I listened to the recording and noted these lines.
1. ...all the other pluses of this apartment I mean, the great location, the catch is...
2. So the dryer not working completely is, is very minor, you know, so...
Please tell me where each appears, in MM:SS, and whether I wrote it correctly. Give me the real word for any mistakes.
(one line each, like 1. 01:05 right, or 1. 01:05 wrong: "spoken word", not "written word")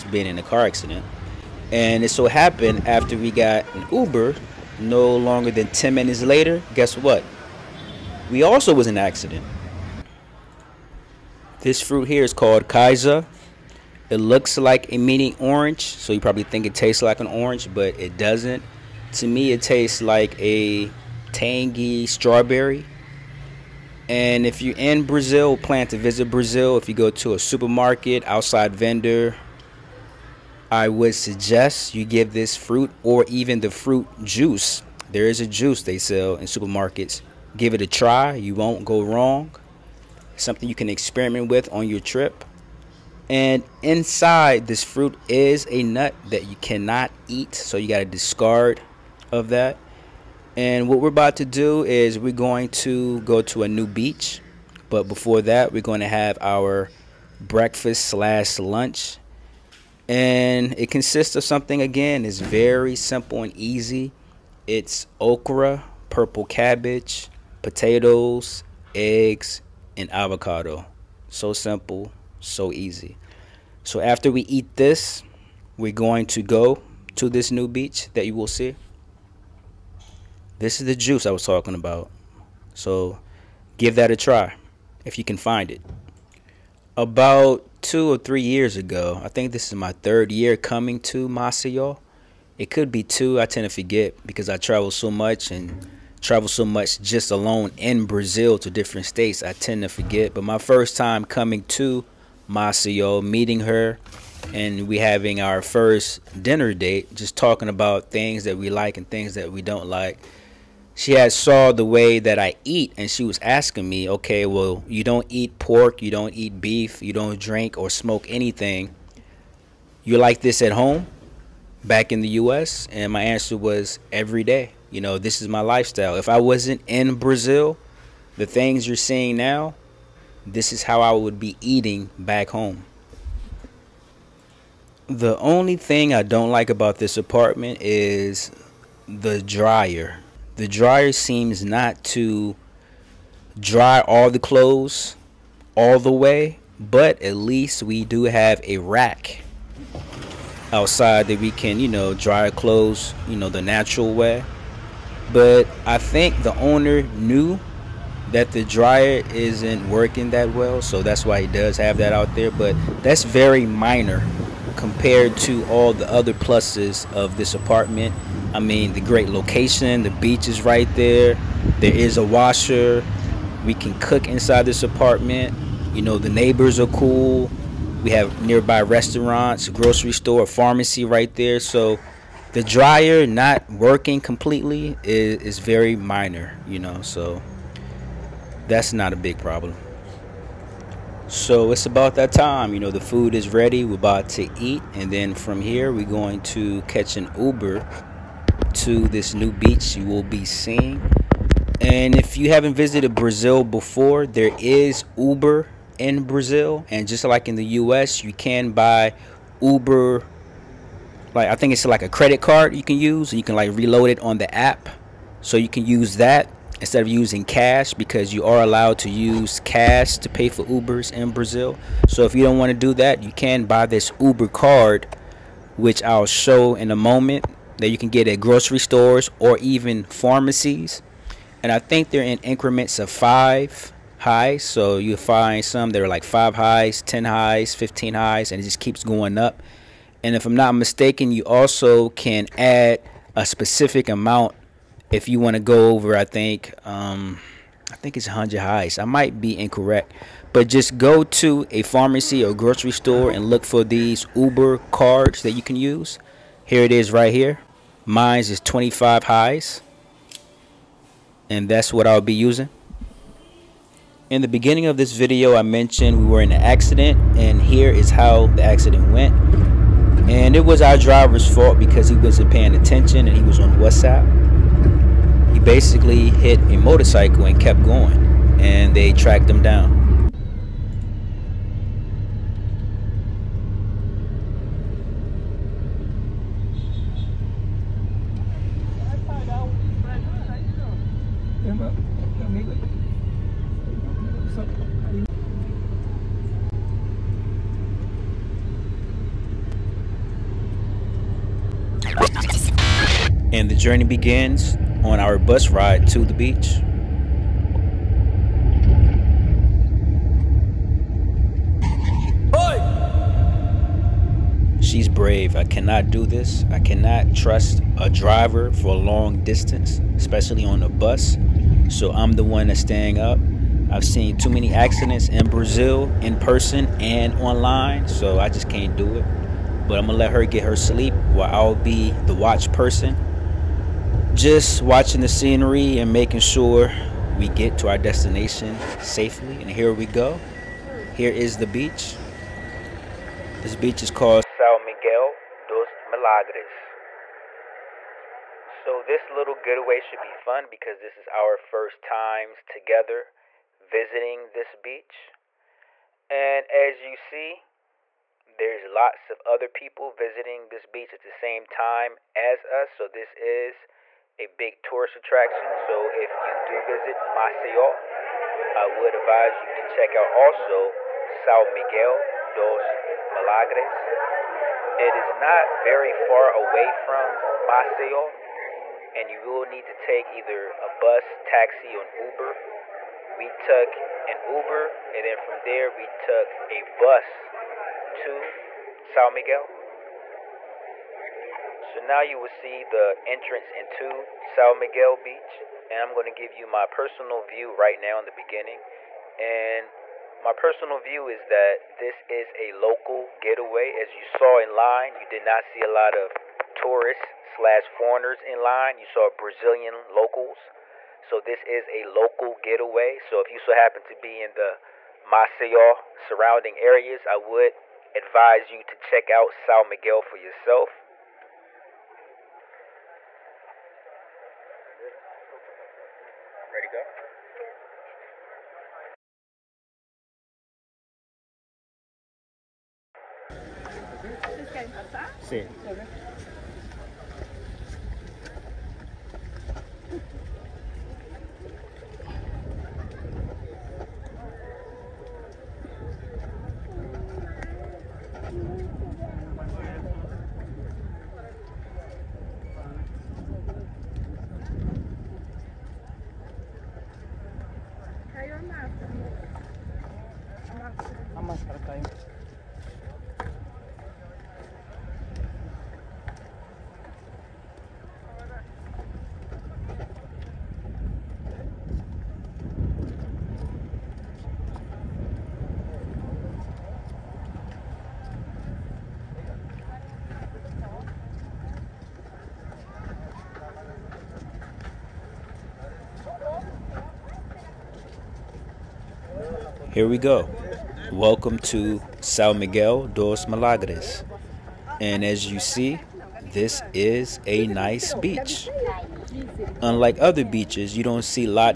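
1. 02:45 wrong: "beach", not "catch"
2. 03:01 right.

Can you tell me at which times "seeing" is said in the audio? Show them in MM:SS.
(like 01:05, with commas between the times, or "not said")
02:08, 03:20.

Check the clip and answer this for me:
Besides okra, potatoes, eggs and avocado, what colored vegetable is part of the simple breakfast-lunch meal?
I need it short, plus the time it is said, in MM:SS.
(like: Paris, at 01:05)
purple cabbage, at 01:06.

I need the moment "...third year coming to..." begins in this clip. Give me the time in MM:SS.
01:29.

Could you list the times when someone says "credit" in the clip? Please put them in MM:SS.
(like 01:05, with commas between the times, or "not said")
03:32.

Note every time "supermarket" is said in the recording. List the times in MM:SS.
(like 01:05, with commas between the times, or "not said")
00:27, 00:36.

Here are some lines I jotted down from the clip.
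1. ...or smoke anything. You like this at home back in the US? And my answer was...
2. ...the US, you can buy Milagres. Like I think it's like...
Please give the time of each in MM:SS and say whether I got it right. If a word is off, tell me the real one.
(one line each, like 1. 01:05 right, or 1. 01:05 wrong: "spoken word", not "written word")
1. 01:57 right
2. 03:27 wrong: "Uber", not "Milagres".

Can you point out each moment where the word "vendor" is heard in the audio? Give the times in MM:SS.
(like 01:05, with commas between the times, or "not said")
00:28.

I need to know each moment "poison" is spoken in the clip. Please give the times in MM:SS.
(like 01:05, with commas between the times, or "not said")
not said.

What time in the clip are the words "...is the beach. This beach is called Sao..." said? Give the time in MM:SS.
05:41.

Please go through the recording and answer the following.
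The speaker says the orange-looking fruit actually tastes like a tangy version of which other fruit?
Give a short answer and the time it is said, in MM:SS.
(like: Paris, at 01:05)
strawberry, at 00:21.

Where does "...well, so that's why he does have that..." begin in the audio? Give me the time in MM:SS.
02:40.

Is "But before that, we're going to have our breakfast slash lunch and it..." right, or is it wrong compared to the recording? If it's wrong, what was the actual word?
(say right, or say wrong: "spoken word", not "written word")
right.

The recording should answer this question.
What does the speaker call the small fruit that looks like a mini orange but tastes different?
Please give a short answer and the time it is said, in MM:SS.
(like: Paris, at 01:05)
Kaiser, at 00:12.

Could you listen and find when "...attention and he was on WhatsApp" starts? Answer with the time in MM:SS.
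04:32.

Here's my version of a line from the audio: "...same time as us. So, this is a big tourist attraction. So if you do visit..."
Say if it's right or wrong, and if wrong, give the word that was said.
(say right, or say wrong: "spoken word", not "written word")
right.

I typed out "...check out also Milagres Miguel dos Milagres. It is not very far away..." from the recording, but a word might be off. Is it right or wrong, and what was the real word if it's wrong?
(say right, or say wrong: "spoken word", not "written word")
wrong: "Sao", not "Milagres".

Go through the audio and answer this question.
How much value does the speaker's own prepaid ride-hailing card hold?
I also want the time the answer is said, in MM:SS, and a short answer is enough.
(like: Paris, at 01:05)
25 reais, at 04:18.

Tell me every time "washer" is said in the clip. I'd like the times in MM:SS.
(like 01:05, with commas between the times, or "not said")
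02:52.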